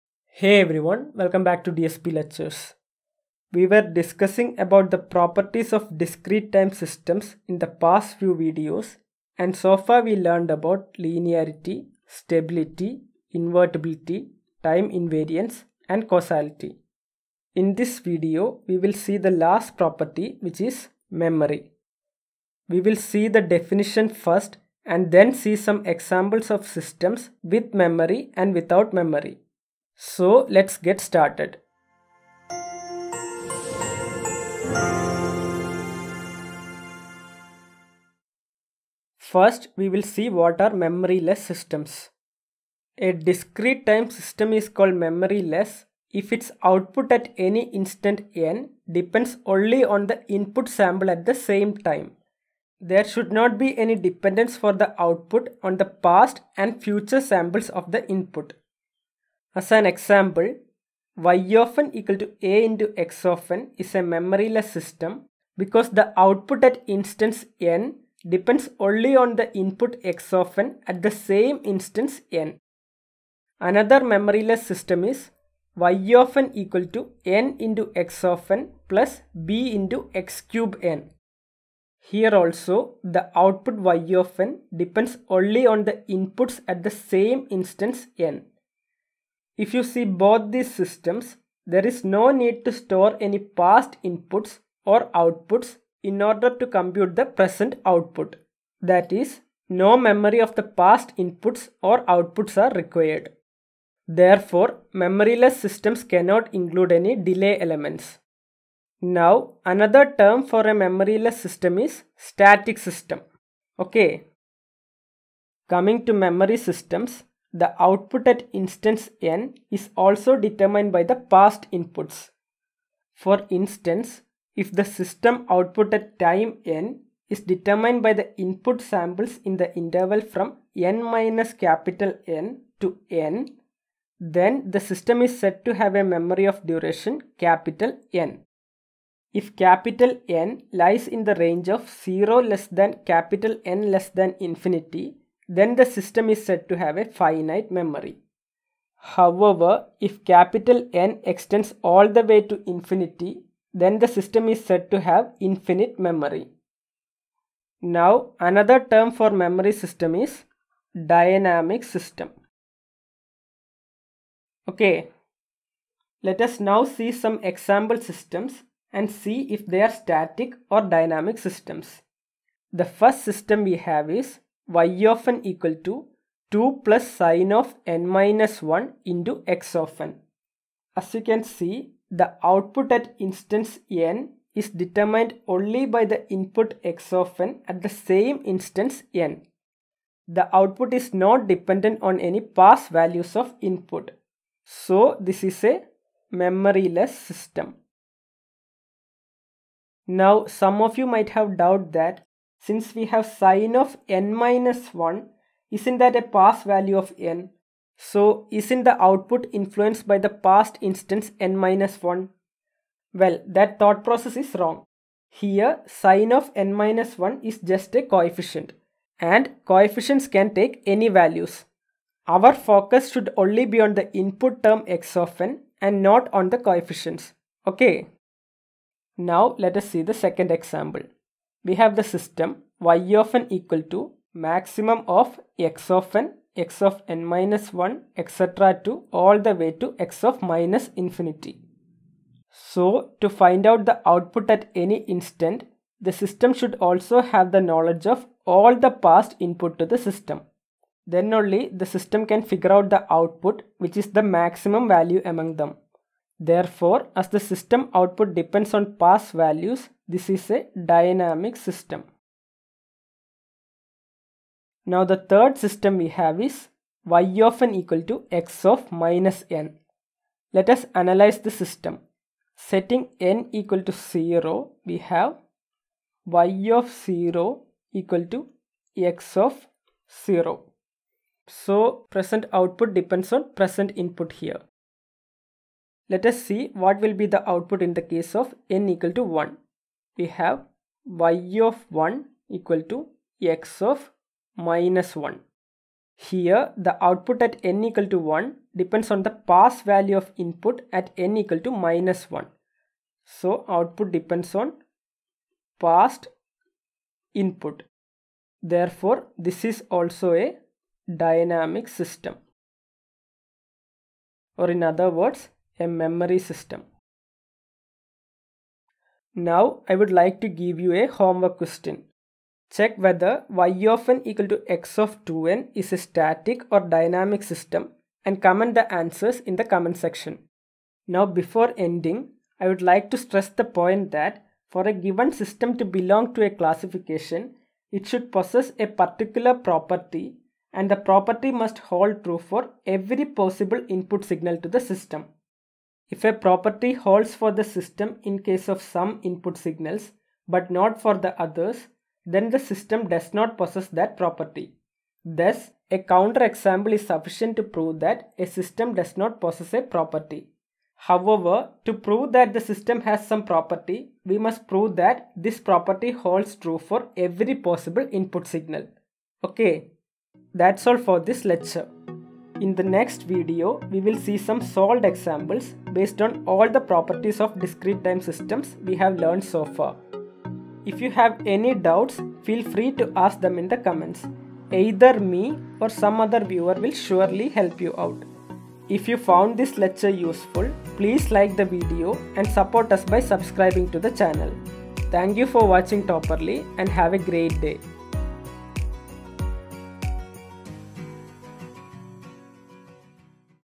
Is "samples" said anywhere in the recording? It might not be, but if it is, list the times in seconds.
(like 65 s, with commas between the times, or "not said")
50 s, 57 s, 128 s.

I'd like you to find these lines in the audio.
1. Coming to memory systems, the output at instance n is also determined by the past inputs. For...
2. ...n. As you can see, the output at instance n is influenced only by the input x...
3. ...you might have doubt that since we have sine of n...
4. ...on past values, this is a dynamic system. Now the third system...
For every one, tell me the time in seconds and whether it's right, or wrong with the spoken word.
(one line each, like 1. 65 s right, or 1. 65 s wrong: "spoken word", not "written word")
1. 115 s right
2. 180 s wrong: "determined", not "influenced"
3. 200 s right
4. 258 s right.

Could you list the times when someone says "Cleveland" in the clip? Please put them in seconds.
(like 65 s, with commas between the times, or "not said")
not said.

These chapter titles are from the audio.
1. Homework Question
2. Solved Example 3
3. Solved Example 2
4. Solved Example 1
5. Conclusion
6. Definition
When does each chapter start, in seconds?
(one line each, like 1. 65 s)
1. 320 s
2. 265 s
3. 231 s
4. 168 s
5. 331 s
6. 39 s.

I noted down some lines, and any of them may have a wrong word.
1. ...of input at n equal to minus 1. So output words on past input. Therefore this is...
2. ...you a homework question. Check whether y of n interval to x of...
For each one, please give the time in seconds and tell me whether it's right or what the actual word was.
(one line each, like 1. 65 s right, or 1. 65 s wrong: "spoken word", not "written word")
1. 300 s wrong: "depends", not "words"
2. 320 s wrong: "equal", not "interval".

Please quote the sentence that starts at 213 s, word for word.
Well, that thought process is wrong.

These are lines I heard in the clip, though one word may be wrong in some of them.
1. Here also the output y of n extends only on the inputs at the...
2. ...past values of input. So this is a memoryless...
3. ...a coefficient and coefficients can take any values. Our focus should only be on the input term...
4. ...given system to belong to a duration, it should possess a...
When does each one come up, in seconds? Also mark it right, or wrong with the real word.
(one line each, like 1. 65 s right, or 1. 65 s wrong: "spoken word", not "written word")
1. 81 s wrong: "depends", not "extends"
2. 192 s right
3. 217 s right
4. 334 s wrong: "classification", not "duration".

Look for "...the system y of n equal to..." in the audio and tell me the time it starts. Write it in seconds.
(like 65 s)
231 s.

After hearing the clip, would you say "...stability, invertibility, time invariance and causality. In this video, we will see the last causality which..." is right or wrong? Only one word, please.
wrong.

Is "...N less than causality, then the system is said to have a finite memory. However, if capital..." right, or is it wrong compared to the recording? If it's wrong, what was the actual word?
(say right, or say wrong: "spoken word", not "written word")
wrong: "infinity", not "causality".